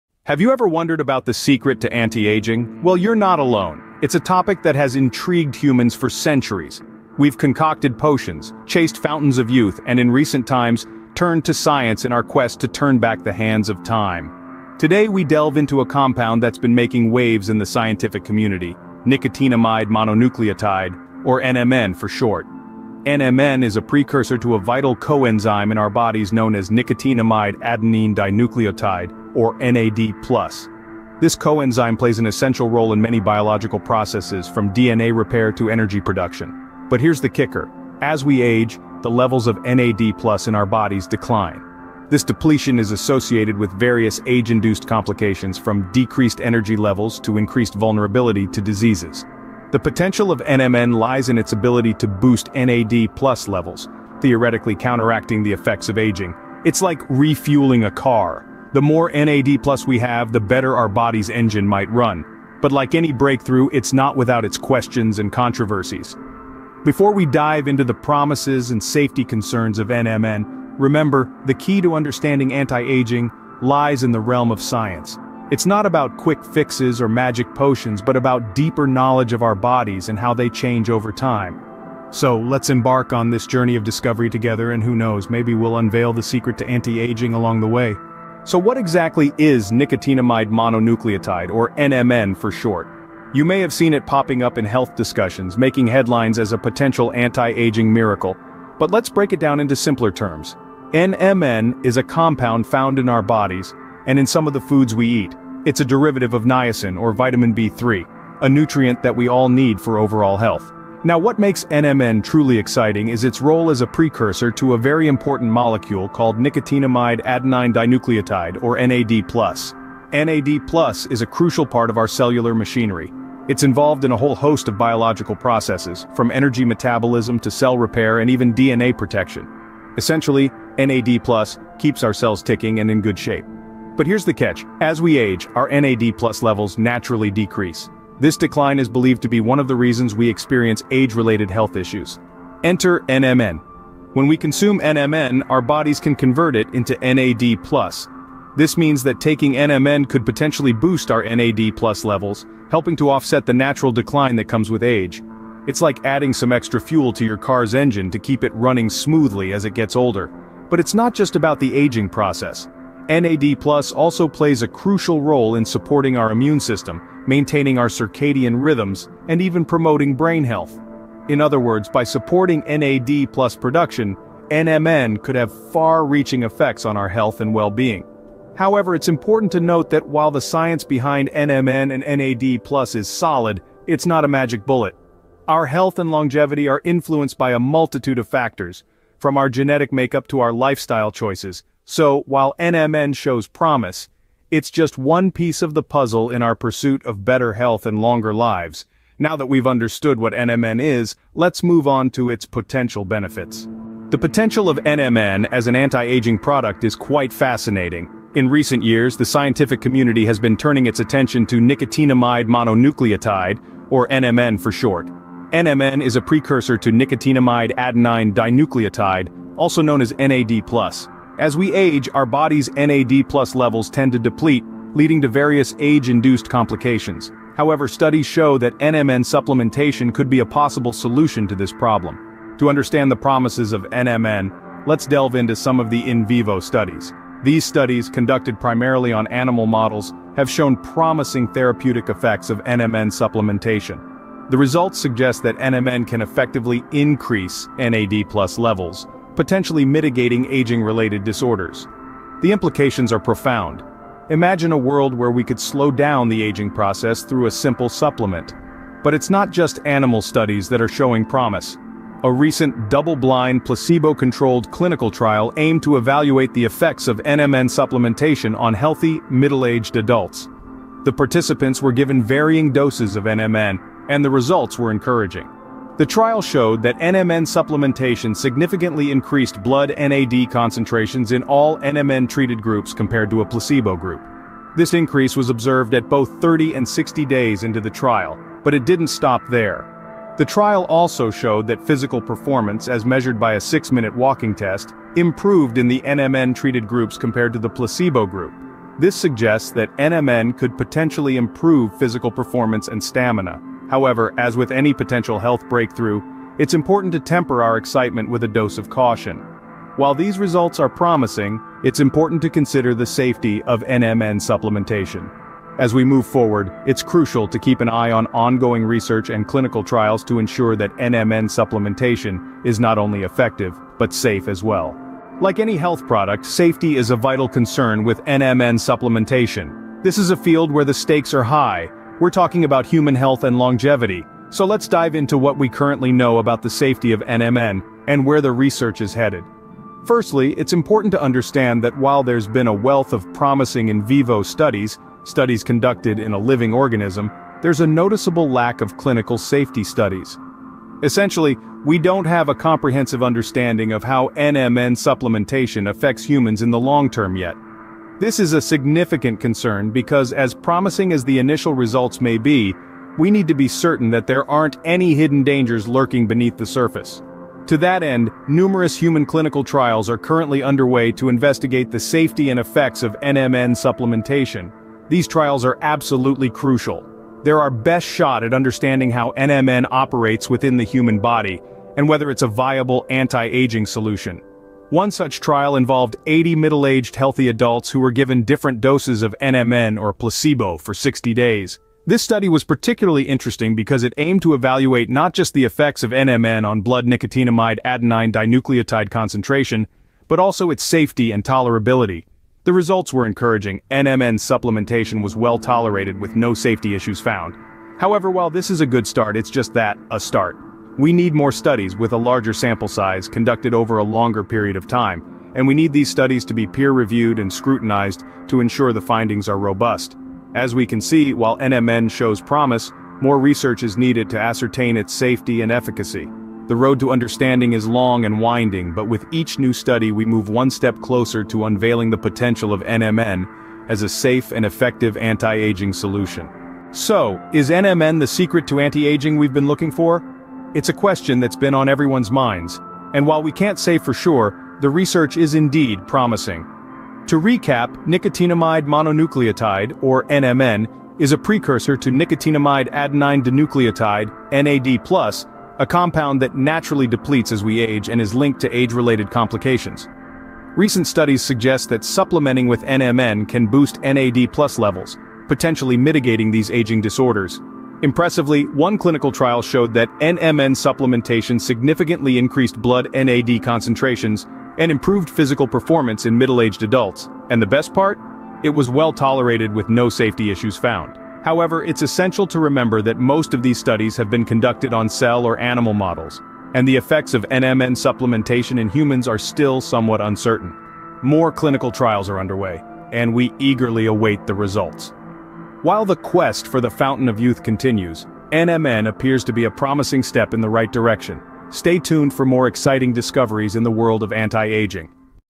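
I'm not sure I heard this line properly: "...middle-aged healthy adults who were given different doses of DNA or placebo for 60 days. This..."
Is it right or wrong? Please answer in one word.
wrong.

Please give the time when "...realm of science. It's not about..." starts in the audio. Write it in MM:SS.
01:14.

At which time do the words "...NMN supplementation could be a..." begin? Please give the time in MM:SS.
03:48.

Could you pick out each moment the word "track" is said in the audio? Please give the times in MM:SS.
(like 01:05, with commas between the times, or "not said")
not said.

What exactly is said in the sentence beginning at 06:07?
To that end, numerous human clinical trials are currently underway to investigate the safety and effects of NMN supplementation.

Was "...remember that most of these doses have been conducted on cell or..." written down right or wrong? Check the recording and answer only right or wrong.
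wrong.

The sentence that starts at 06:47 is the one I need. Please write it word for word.
However, while this is a good start, it's just that, a start.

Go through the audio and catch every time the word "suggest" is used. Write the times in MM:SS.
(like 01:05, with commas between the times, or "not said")
04:04, 04:59, 07:41.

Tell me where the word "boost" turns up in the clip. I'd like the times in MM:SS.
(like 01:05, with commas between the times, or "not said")
00:52, 02:30, 07:43.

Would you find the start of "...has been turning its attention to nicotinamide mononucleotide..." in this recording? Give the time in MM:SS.
03:30.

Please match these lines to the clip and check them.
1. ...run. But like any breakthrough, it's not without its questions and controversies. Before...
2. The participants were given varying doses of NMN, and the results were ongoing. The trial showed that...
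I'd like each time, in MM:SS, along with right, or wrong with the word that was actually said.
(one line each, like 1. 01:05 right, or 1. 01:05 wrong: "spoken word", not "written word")
1. 01:01 right
2. 04:31 wrong: "encouraging", not "ongoing".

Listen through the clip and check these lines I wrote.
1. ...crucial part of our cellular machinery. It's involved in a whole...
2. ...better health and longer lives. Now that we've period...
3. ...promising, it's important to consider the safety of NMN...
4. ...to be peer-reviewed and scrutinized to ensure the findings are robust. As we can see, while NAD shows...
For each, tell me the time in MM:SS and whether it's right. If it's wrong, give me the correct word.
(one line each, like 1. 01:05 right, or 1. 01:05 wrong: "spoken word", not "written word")
1. 02:01 right
2. 03:17 wrong: "understood", not "period"
3. 05:10 right
4. 06:56 wrong: "NMN", not "NAD".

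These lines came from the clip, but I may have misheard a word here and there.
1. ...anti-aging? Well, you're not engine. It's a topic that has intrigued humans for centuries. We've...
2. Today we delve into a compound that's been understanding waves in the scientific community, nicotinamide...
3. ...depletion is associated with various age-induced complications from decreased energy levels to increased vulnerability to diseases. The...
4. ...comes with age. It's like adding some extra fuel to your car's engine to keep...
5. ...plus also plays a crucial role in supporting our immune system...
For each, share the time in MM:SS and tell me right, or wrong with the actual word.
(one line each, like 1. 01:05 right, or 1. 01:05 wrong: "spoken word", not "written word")
1. 00:01 wrong: "alone", not "engine"
2. 00:14 wrong: "making", not "understanding"
3. 00:42 right
4. 02:34 right
5. 02:43 right.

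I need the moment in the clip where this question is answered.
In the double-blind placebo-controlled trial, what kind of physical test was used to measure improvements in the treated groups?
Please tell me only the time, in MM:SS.
04:53.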